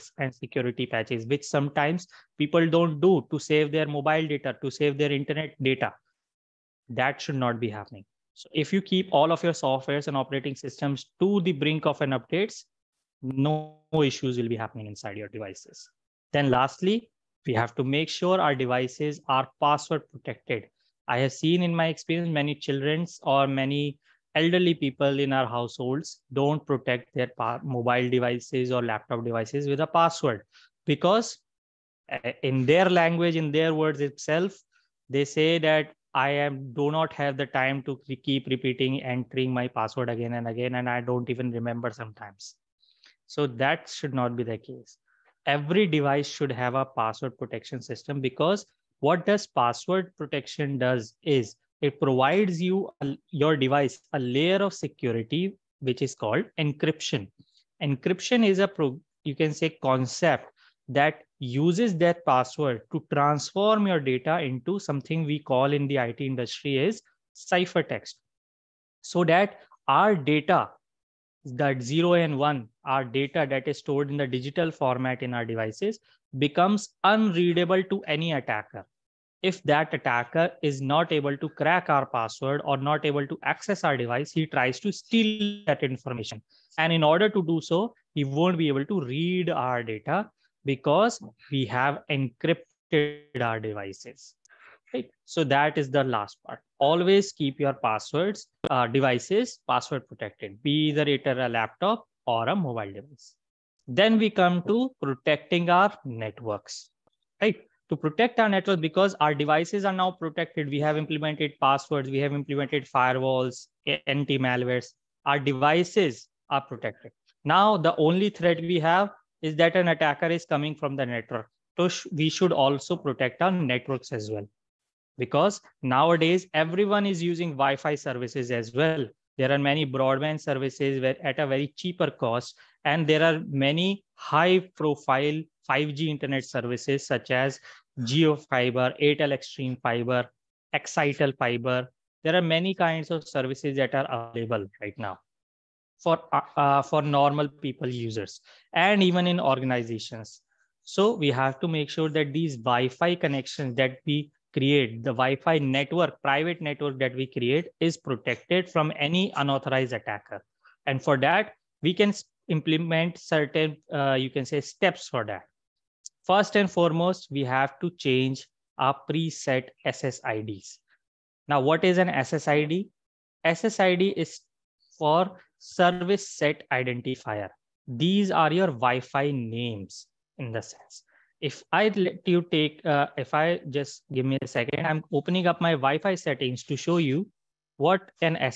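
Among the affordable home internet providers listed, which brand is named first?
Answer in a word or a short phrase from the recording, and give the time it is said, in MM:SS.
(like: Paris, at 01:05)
JioFiber, at 02:17.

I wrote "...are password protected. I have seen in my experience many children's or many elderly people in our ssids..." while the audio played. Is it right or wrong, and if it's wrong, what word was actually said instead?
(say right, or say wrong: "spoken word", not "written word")
wrong: "households", not "ssids".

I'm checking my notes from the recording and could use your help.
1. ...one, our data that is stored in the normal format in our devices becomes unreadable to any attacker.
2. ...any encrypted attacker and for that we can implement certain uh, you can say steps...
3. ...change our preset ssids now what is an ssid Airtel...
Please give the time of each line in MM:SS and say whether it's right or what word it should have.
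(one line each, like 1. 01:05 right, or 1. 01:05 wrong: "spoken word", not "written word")
1. 01:12 wrong: "digital", not "normal"
2. 02:38 wrong: "unauthorized", not "encrypted"
3. 02:48 wrong: "SSID", not "Airtel".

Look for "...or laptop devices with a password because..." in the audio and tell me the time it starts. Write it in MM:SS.
00:28.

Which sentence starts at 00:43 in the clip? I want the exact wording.
So that should not be the case.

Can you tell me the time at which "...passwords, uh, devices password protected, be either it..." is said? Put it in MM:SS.
01:37.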